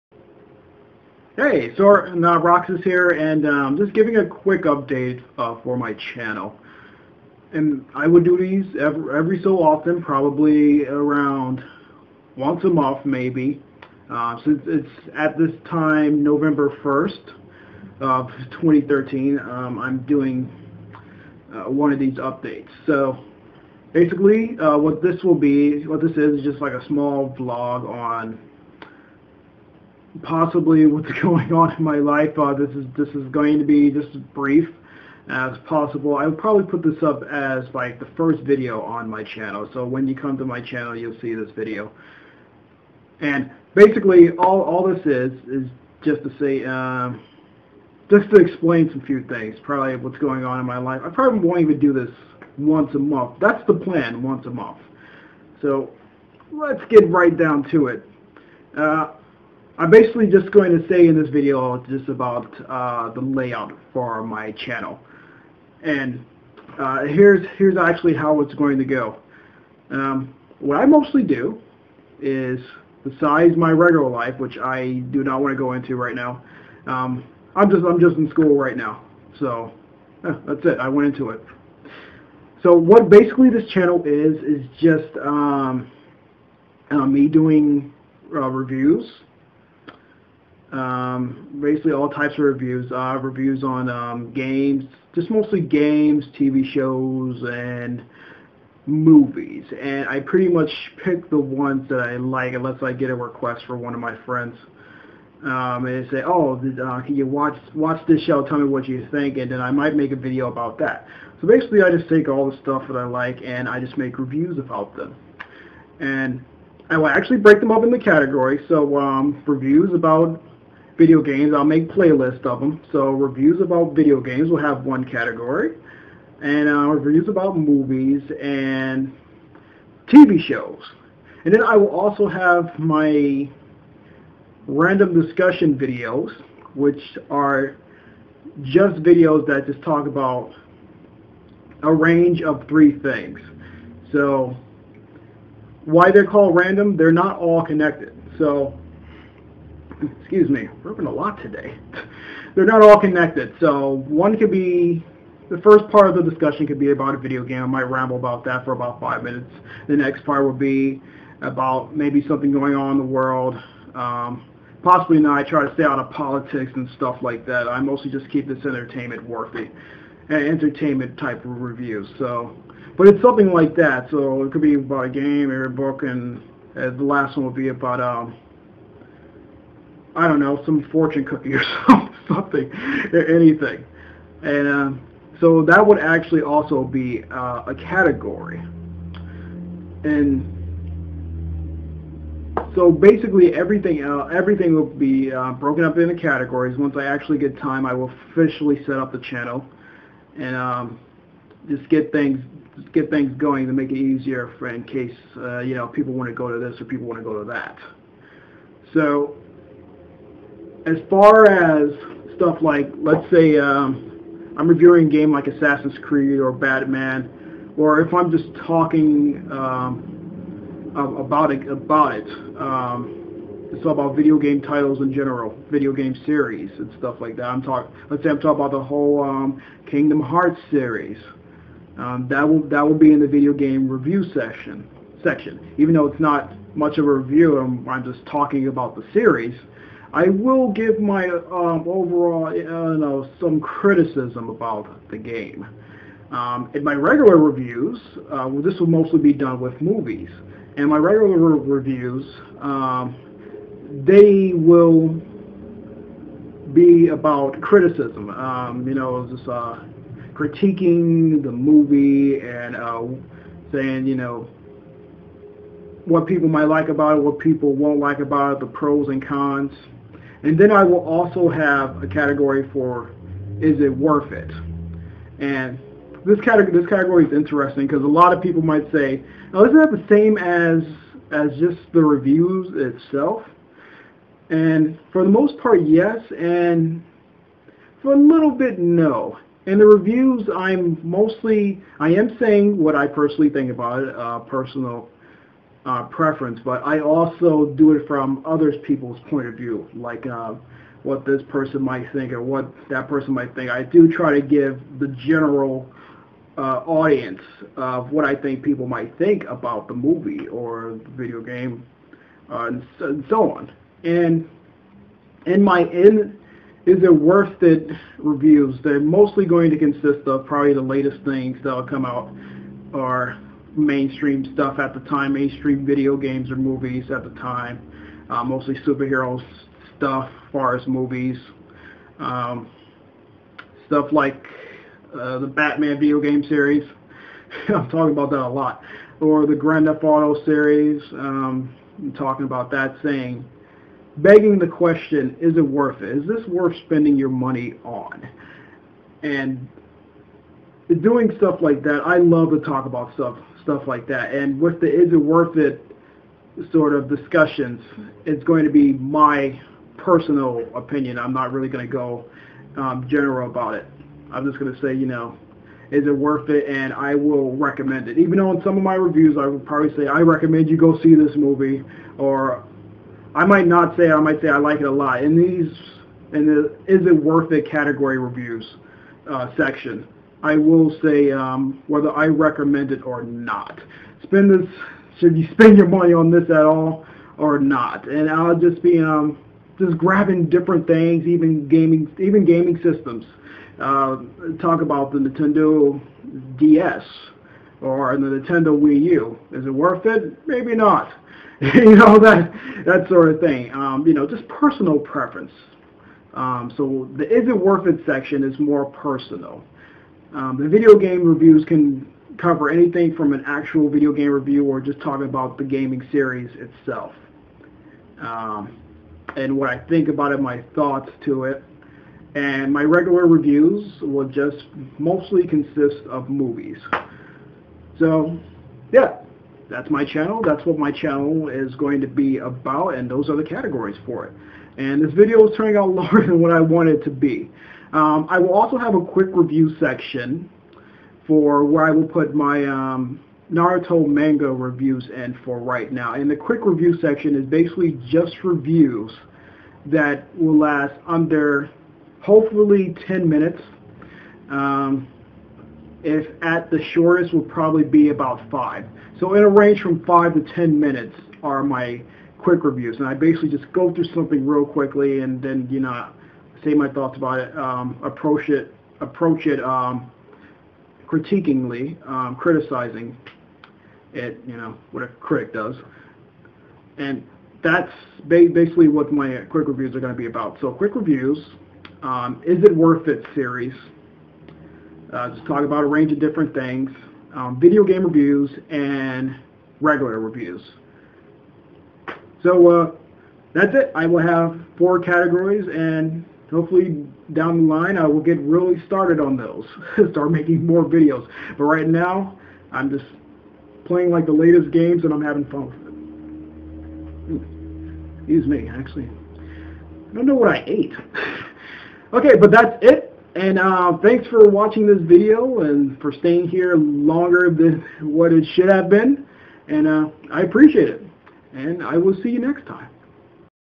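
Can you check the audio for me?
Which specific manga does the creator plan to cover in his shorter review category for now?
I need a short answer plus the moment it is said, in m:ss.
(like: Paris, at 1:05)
Naruto, at 7:23.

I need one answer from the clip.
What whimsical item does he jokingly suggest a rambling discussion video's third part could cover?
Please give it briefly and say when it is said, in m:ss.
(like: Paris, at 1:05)
fortune cookie, at 3:00.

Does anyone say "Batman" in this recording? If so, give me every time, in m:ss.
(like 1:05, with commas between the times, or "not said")
3:36, 5:35.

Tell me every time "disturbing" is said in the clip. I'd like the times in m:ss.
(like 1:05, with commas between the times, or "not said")
not said.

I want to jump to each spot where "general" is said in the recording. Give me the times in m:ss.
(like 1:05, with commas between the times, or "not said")
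3:45, 5:05, 6:03.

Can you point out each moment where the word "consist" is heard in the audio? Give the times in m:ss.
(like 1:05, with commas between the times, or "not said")
5:19, 7:05.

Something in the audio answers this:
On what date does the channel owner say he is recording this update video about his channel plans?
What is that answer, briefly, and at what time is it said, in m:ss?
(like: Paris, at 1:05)
November 1st, 2013, at 0:16.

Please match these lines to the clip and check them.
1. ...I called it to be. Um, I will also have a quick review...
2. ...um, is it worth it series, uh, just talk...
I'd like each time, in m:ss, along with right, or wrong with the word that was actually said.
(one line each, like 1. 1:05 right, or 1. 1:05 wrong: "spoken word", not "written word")
1. 7:16 wrong: "wanted", not "called"
2. 8:02 right.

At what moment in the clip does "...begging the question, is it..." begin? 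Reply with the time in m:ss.
5:44.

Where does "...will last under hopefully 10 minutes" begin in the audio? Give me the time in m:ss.
7:30.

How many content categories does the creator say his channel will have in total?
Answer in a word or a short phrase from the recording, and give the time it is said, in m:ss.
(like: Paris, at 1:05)
4, at 8:14.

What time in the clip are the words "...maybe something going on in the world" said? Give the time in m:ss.
2:41.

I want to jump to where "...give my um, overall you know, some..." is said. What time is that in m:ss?
4:00.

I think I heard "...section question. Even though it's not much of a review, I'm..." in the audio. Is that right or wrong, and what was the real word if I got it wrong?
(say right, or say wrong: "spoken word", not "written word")
wrong: "section", not "question".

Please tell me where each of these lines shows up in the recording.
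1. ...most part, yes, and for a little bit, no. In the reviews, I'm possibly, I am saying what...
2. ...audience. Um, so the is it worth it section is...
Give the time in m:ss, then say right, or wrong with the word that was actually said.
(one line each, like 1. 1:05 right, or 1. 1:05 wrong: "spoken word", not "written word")
1. 4:45 wrong: "mostly", not "possibly"
2. 6:44 wrong: "preference", not "audience".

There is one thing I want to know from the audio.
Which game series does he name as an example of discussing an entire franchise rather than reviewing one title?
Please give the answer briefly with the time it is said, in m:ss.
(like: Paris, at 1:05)
Kingdom Hearts, at 3:49.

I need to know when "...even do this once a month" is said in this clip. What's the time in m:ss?
0:51.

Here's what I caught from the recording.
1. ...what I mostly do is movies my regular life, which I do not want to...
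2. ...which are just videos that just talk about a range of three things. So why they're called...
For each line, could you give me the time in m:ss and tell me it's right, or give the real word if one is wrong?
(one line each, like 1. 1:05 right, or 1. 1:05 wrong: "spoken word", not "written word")
1. 1:10 wrong: "besides", not "movies"
2. 2:16 right.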